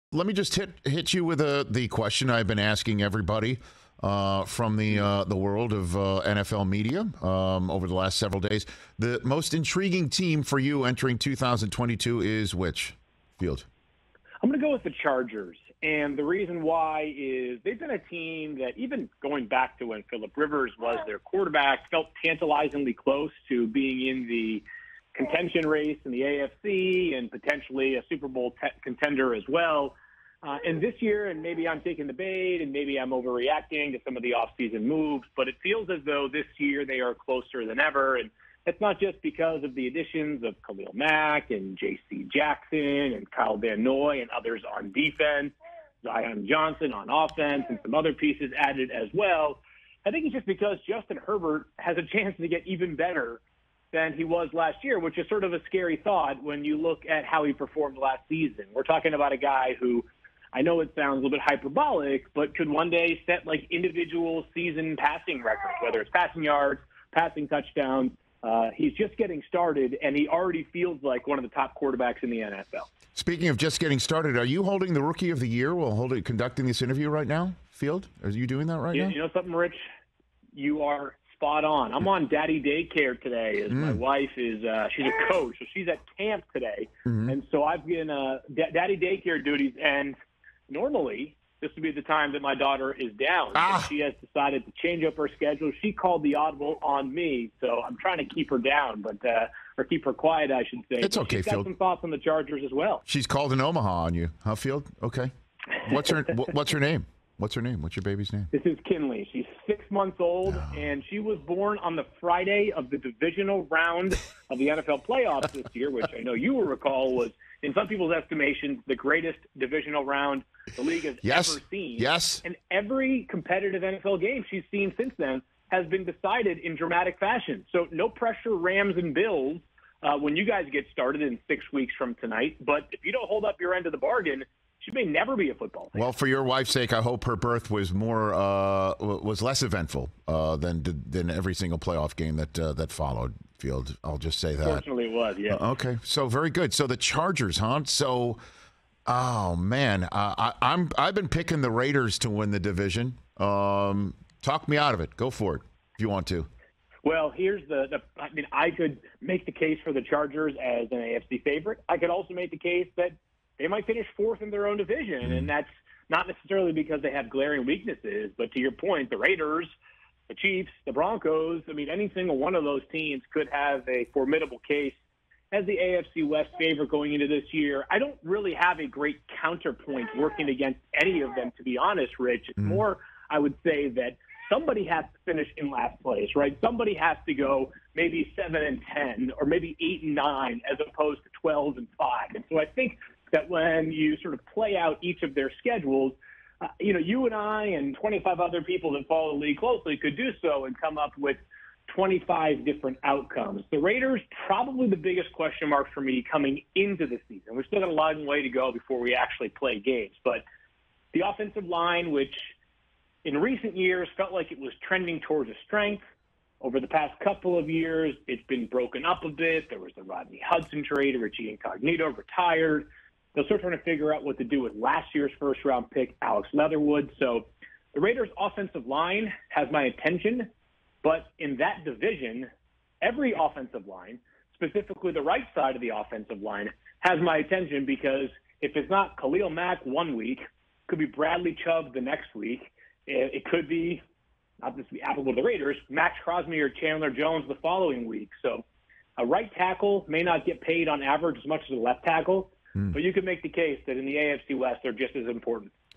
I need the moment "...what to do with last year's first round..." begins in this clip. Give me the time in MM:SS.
03:44.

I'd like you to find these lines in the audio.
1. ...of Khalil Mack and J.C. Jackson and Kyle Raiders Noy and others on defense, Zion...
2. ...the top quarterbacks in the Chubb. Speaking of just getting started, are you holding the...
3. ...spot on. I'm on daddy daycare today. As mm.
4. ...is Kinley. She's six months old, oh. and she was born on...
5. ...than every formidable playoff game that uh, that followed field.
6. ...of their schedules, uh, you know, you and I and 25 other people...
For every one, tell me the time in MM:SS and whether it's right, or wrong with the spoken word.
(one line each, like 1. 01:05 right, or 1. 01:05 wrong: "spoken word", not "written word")
1. 00:40 wrong: "Van", not "Raiders"
2. 01:11 wrong: "NFL", not "Chubb"
3. 01:21 right
4. 01:48 right
5. 02:21 wrong: "single", not "formidable"
6. 03:15 right.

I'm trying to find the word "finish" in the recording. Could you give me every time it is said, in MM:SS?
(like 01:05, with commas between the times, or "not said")
02:43, 03:05.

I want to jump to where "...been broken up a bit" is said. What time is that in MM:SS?
03:38.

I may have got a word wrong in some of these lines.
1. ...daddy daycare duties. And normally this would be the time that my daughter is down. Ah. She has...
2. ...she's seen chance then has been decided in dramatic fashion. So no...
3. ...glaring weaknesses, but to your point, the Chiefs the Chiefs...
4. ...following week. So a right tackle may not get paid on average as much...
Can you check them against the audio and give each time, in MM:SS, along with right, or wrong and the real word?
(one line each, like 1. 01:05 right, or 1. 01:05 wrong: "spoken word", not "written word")
1. 01:28 right
2. 02:04 wrong: "since", not "chance"
3. 02:47 wrong: "Raiders", not "Chiefs"
4. 04:07 right.